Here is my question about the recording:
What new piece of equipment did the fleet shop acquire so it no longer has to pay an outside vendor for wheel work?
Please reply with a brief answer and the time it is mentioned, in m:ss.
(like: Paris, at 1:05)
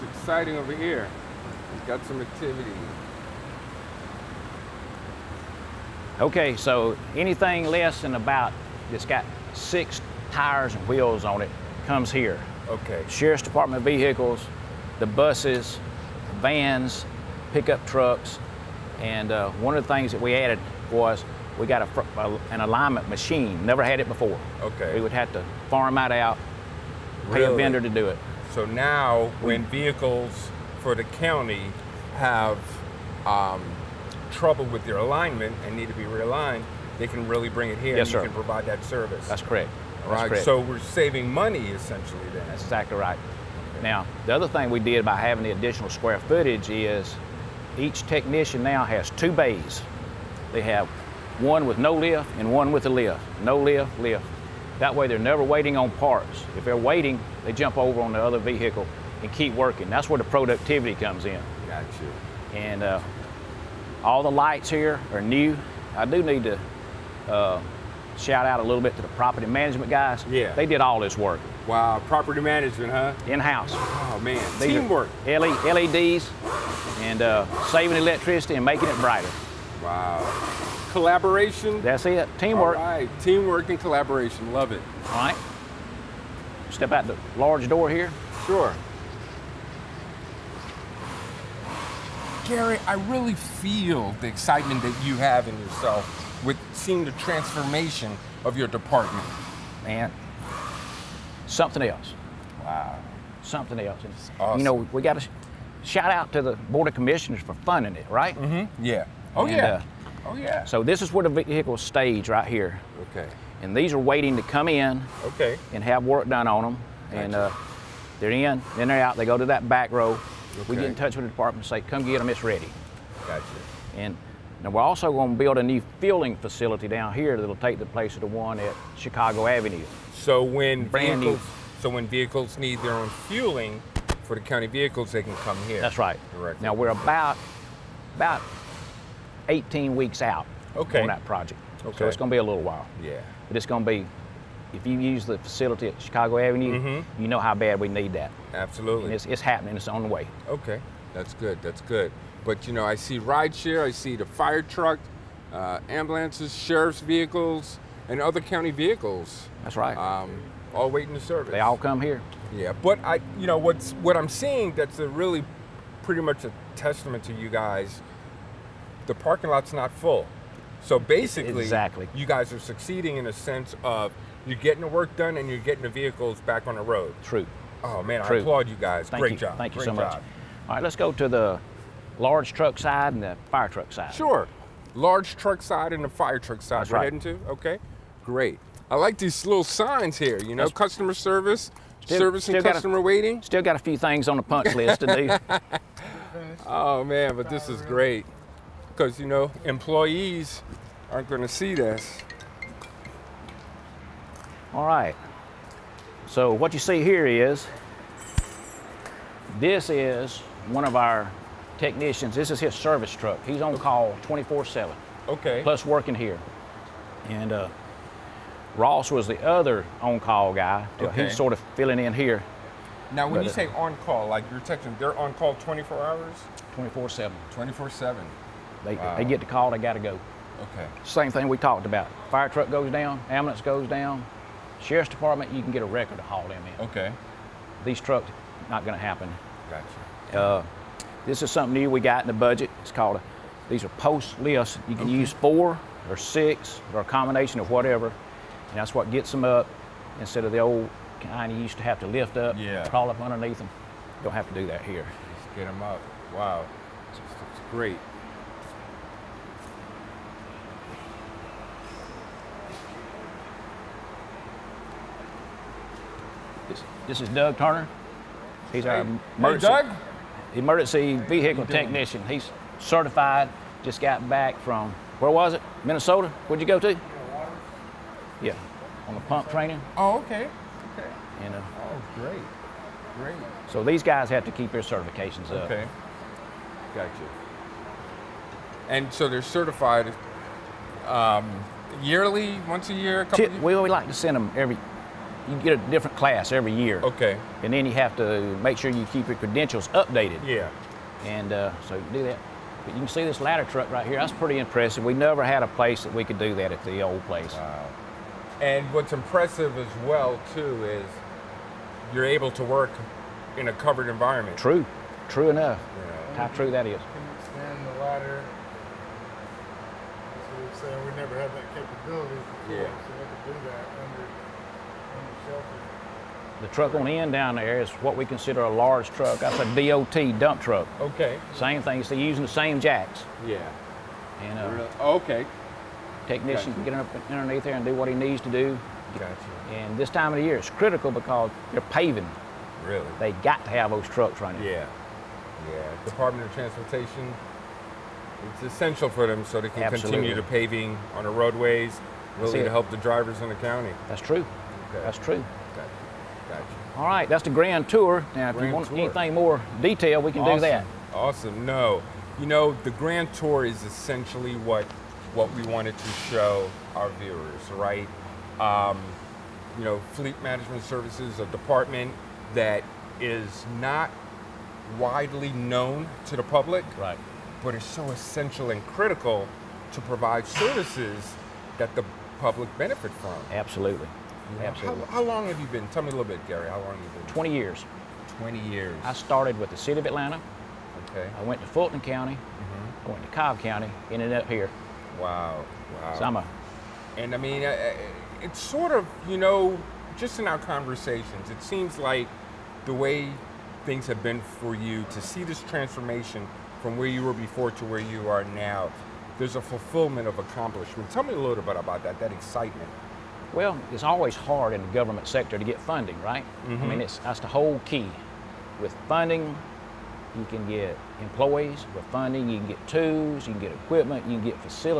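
Alignment machine, at 0:22.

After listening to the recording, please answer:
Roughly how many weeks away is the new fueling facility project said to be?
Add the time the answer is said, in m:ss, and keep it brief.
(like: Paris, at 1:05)
18 weeks, at 2:19.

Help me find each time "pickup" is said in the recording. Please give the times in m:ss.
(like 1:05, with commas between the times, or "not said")
0:17.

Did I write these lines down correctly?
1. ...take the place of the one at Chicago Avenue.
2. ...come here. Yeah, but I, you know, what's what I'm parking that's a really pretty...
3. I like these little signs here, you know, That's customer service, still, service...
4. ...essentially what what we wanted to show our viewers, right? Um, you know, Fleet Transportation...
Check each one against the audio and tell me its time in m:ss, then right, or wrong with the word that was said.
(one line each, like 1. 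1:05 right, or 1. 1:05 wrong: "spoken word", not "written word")
1. 2:07 right
2. 2:41 wrong: "seeing", not "parking"
3. 3:08 right
4. 6:03 wrong: "Management", not "Transportation".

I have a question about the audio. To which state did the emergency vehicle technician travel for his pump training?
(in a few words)
Minnesota.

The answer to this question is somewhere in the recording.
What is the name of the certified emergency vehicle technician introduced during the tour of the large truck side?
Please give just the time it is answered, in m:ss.
4:27.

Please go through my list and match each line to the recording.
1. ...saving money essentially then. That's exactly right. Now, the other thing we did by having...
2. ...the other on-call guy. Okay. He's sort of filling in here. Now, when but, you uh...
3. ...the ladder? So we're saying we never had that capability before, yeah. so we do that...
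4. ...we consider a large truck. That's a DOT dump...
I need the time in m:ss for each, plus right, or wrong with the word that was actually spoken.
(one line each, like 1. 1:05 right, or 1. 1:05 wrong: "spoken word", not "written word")
1. 0:40 right
2. 3:39 right
3. 5:17 right
4. 5:28 right.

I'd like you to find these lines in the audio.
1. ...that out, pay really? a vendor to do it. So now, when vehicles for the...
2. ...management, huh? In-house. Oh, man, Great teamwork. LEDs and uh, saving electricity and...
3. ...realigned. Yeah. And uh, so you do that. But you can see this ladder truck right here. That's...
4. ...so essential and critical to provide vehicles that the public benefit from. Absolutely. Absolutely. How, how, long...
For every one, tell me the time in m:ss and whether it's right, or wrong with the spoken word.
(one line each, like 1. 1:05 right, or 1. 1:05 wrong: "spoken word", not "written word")
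1. 0:25 right
2. 1:12 wrong: "These", not "Great"
3. 4:59 wrong: "updated", not "realigned"
4. 6:17 wrong: "services", not "vehicles".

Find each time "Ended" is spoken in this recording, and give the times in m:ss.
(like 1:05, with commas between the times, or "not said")
6:34.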